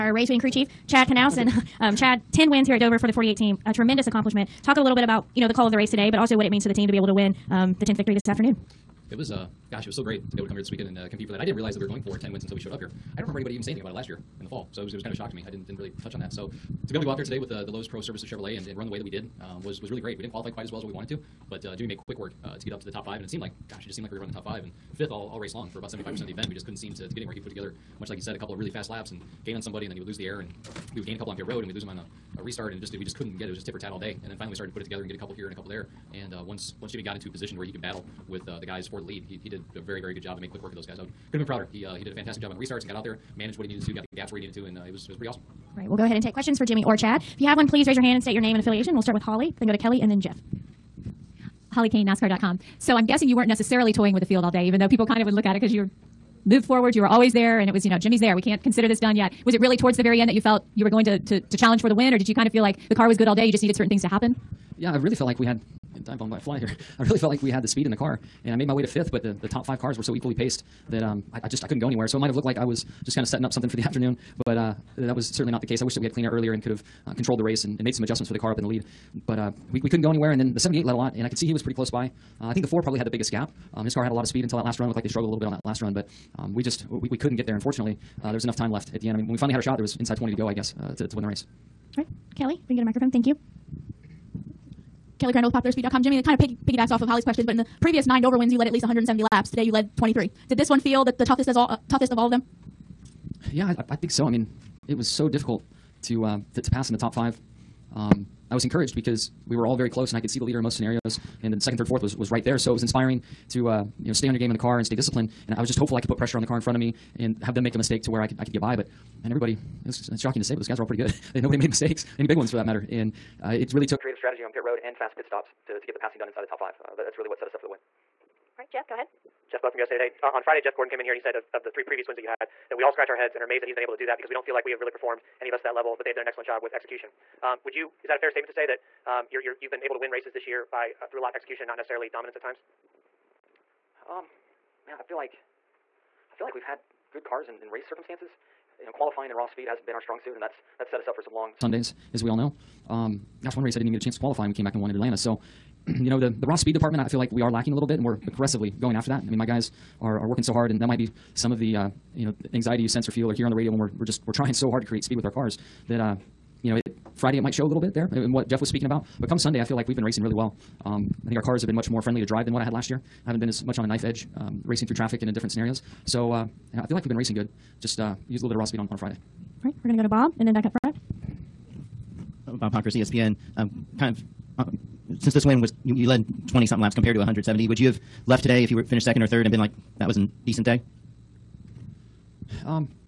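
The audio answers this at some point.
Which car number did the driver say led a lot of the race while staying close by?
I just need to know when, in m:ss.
1:20.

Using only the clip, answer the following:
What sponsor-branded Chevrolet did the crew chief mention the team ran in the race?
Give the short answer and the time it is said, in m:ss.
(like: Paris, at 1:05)
Lowe's Pro Services, at 0:17.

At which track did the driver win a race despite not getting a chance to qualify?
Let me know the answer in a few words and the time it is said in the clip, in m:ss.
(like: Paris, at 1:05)
Atlanta, at 2:34.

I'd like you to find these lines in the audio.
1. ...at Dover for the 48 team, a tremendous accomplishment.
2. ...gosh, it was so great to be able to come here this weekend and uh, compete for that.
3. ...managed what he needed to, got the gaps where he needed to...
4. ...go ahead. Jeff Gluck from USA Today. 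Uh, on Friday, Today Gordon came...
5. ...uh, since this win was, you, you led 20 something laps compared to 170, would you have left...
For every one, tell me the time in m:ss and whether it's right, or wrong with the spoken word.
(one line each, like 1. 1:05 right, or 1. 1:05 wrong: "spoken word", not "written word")
1. 0:02 right
2. 0:09 right
3. 0:43 right
4. 2:08 wrong: "Jeff", not "Today"
5. 3:04 right.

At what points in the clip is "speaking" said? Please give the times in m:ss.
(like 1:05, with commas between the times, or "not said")
2:48.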